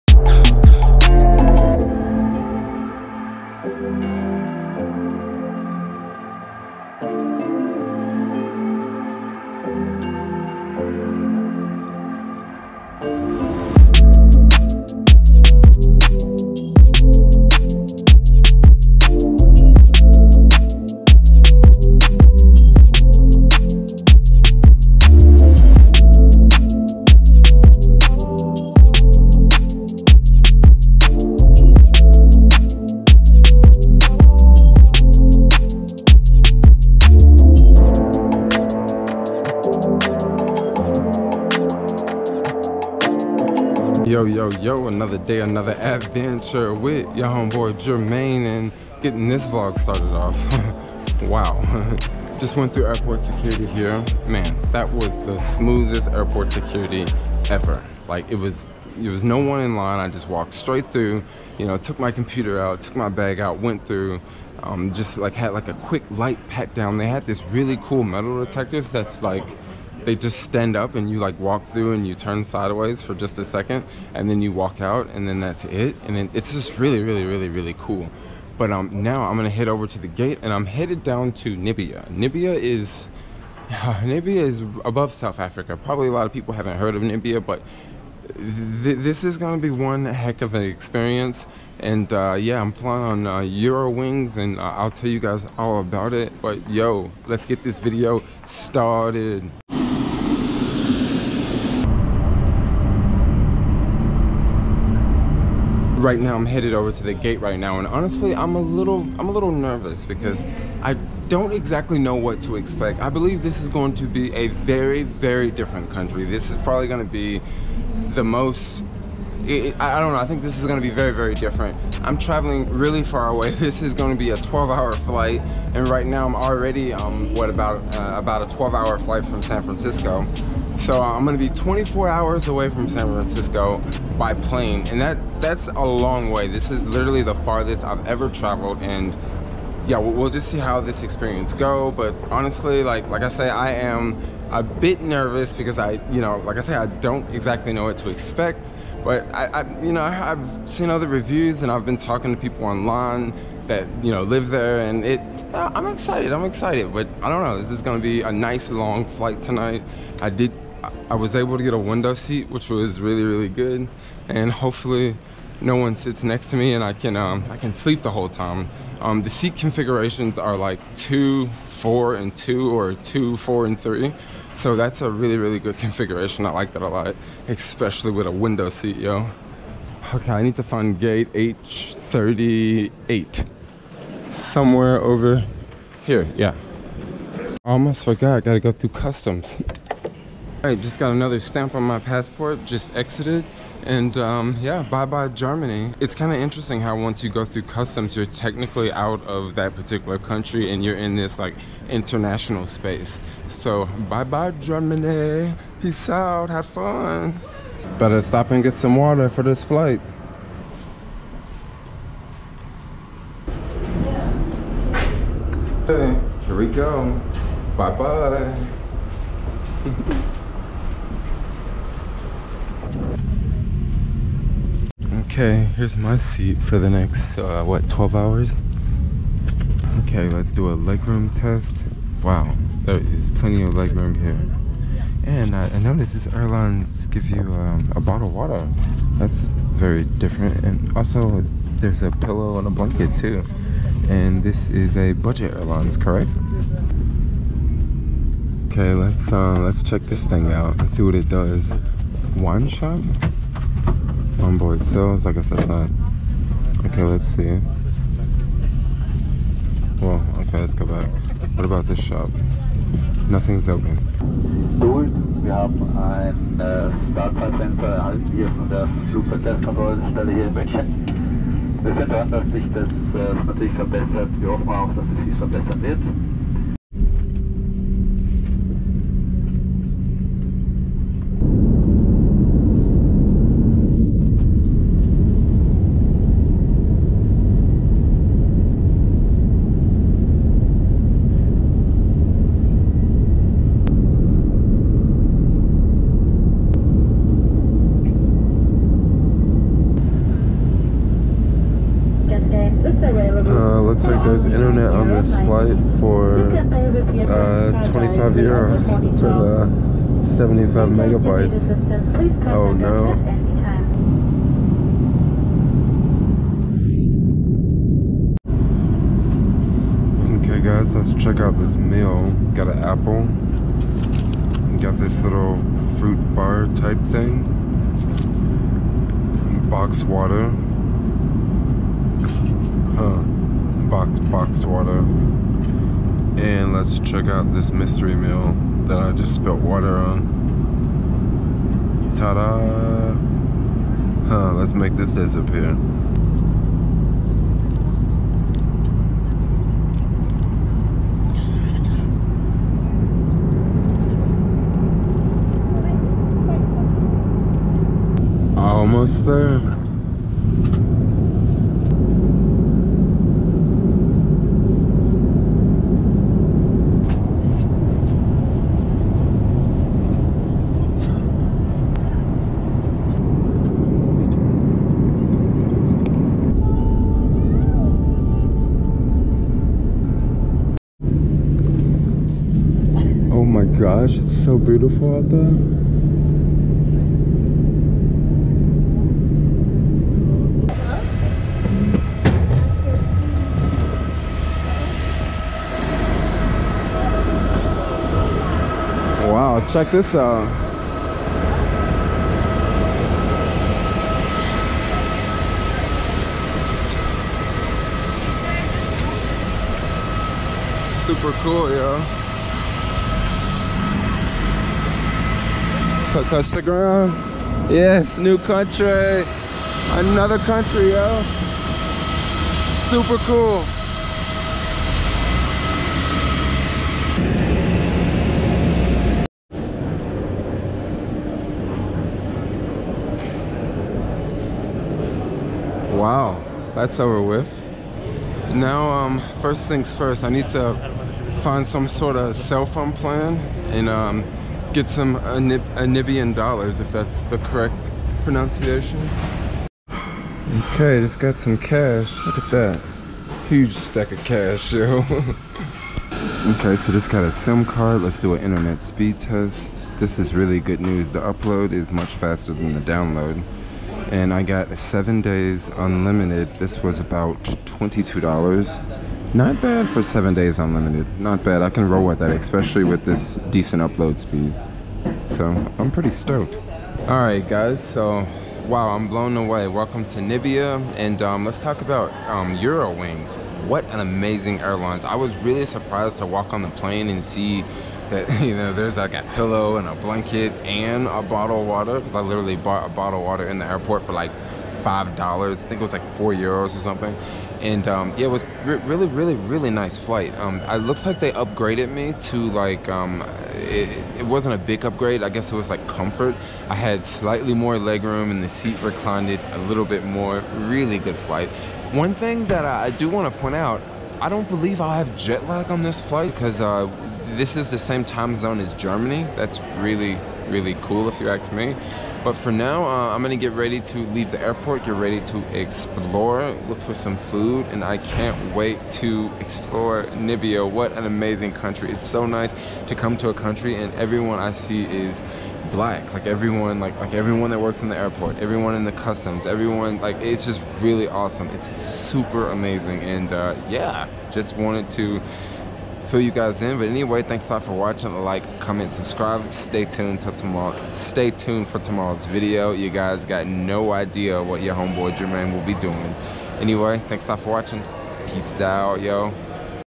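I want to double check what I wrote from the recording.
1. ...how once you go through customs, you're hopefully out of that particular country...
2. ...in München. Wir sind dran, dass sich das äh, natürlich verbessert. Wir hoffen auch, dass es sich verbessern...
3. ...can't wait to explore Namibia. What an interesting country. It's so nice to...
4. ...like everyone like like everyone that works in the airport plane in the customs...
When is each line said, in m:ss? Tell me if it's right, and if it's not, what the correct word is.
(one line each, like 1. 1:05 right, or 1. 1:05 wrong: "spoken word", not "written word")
1. 3:16 wrong: "technically", not "hopefully"
2. 4:30 right
3. 8:47 wrong: "amazing", not "interesting"
4. 8:56 wrong: "everyone", not "plane".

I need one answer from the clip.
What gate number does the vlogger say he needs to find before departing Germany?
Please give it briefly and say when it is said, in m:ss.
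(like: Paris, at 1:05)
H38, at 3:01.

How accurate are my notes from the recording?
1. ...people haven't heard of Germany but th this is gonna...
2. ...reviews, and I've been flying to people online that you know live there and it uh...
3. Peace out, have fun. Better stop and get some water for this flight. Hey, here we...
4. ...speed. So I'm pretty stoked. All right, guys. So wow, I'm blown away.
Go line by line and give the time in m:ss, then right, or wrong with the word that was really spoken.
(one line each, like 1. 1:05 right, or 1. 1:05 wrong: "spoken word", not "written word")
1. 1:26 wrong: "Namibia", not "Germany"
2. 2:31 wrong: "talking", not "flying"
3. 3:25 right
4. 7:54 right.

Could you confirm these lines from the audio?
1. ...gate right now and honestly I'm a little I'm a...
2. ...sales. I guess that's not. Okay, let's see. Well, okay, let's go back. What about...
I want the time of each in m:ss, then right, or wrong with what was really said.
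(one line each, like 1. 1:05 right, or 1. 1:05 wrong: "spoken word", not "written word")
1. 1:47 right
2. 4:14 right.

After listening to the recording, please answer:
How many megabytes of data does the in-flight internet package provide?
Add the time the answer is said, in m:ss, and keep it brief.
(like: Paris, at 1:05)
75, at 5:10.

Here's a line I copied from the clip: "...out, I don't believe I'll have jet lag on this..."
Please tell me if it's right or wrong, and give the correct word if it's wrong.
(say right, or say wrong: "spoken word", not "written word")
right.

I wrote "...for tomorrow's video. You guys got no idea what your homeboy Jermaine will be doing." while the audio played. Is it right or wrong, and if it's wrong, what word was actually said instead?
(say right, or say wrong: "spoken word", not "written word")
right.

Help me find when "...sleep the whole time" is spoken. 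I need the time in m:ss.
2:47.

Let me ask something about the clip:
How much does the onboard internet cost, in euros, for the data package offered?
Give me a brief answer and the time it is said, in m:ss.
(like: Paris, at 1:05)
25 euros, at 5:07.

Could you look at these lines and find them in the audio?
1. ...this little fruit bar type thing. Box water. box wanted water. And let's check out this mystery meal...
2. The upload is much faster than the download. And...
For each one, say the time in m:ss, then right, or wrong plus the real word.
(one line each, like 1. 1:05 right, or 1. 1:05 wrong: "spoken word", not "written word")
1. 5:24 wrong: "boxed", not "wanted"
2. 7:41 right.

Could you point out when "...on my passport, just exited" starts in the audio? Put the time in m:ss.
3:11.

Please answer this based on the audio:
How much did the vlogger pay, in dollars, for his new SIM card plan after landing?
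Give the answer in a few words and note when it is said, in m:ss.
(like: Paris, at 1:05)
$22, at 7:47.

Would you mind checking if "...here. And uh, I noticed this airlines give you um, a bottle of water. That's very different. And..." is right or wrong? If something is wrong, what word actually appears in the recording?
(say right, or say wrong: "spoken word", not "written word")
right.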